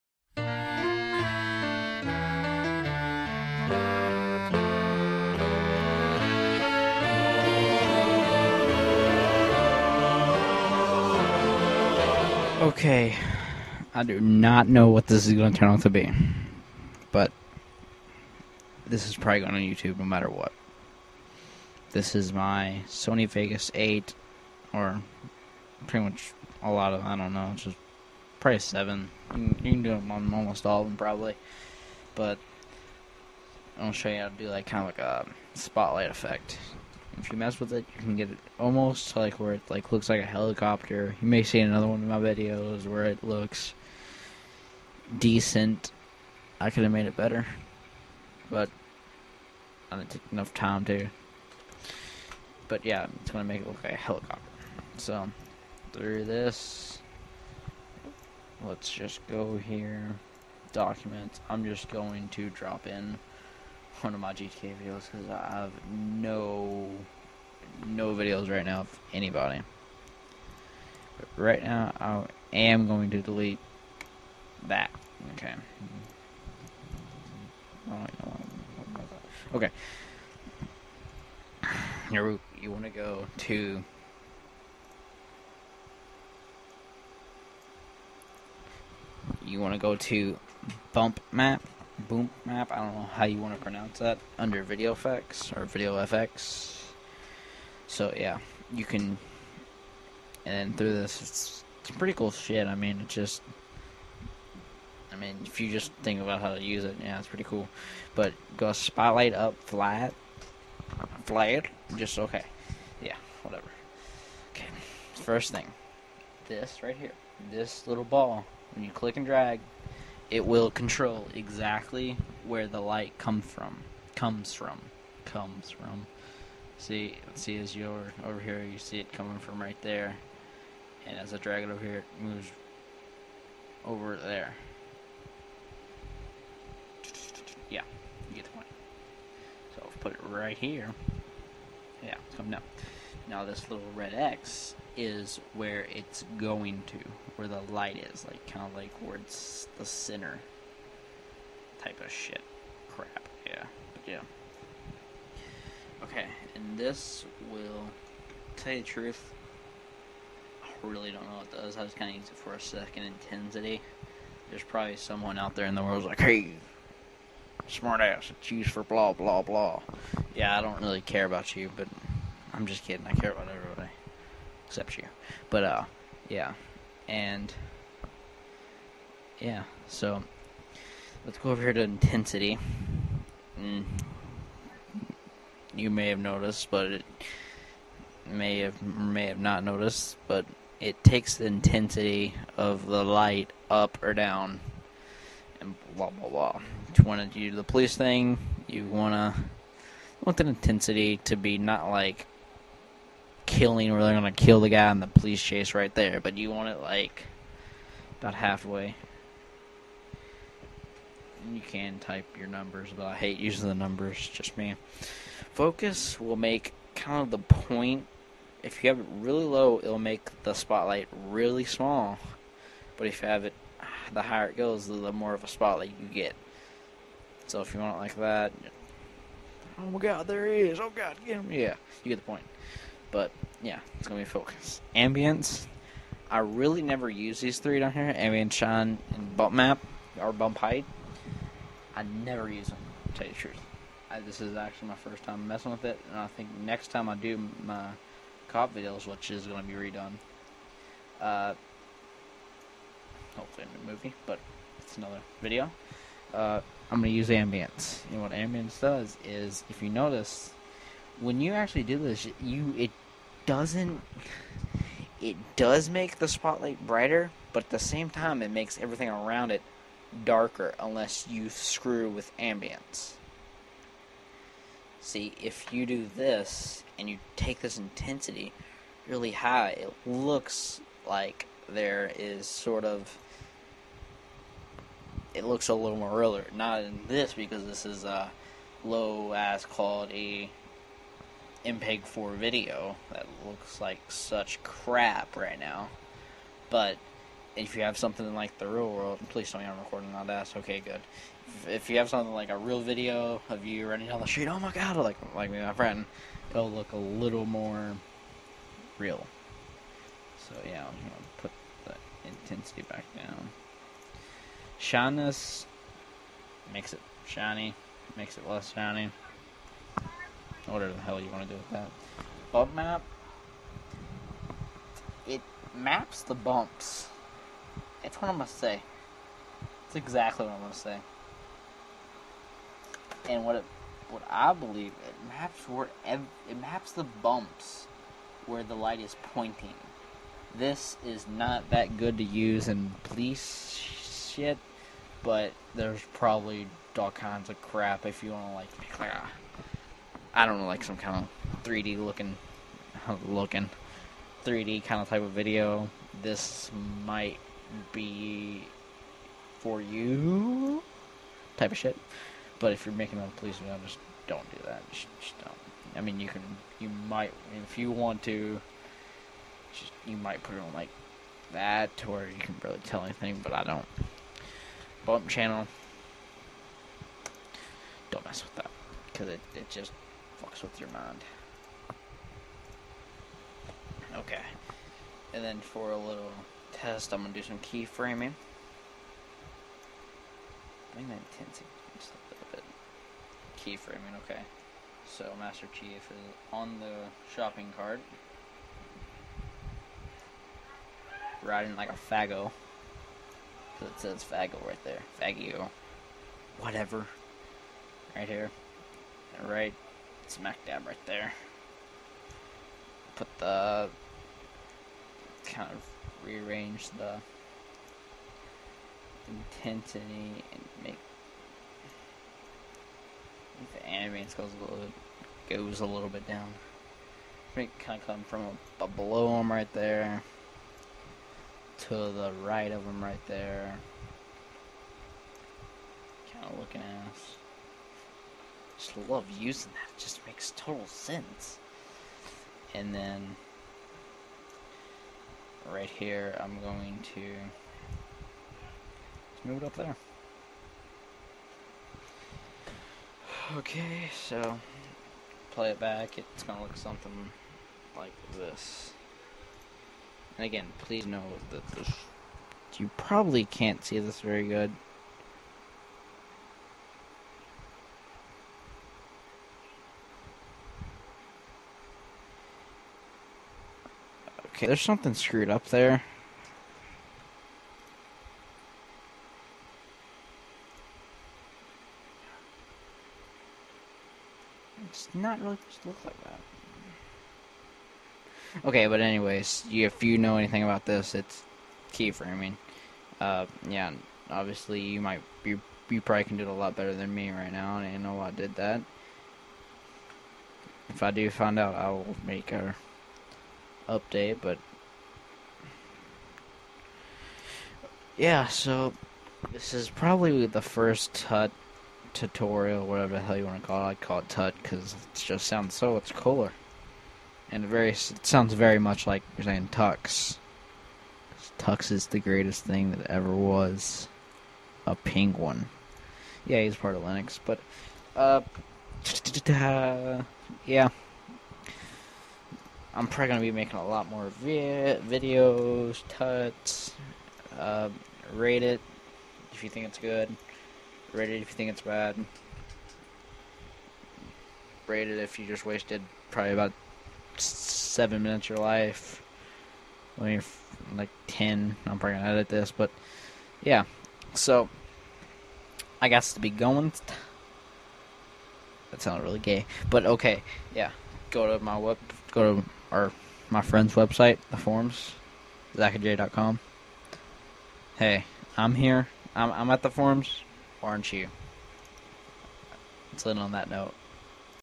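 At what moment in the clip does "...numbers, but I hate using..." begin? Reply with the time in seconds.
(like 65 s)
212 s.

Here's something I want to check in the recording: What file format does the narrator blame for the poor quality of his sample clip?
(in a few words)
MPEG 4.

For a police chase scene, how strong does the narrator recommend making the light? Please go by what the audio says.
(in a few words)
about halfway.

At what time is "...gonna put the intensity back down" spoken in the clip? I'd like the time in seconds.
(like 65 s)
311 s.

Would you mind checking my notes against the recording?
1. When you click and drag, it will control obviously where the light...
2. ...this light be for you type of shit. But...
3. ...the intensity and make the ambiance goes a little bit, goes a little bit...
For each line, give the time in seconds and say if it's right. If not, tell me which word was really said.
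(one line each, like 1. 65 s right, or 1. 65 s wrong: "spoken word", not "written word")
1. 118 s wrong: "exactly", not "obviously"
2. 356 s wrong: "might", not "light"
3. 416 s right.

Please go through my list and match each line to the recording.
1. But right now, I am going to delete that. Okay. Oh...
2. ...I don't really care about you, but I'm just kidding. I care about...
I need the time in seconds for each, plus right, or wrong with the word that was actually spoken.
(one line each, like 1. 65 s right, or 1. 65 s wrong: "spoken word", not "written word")
1. 71 s right
2. 170 s right.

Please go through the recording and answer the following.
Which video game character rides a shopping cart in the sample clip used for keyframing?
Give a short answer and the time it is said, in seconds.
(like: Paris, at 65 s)
Master Chief, at 395 s.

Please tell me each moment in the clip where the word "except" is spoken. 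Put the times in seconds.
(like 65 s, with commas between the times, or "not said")
174 s.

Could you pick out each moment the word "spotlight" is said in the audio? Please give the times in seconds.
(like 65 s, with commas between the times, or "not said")
35 s, 108 s, 220 s, 225 s, 266 s.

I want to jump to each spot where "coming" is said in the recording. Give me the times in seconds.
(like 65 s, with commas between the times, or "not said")
129 s, 142 s.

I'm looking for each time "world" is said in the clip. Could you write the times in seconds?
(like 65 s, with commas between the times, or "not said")
165 s, 298 s.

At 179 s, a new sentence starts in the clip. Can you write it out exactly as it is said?
So let's go over here to intensity.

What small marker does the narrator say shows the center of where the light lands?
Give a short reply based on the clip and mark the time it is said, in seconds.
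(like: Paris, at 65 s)
little red X, at 143 s.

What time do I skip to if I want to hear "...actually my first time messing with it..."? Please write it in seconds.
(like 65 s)
244 s.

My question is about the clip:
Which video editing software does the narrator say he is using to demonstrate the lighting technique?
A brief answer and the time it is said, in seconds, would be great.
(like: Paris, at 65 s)
Sony Vegas 8, at 22 s.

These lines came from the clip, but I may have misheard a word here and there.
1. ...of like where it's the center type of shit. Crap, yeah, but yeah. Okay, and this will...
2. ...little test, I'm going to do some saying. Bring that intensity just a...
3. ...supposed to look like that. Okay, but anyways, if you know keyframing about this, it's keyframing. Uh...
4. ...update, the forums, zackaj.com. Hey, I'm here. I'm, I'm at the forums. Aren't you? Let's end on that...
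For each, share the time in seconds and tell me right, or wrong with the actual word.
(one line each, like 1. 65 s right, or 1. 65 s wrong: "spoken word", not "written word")
1. 148 s right
2. 385 s wrong: "keyframing", not "saying"
3. 485 s wrong: "anything", not "keyframing"
4. 563 s wrong: "website", not "update".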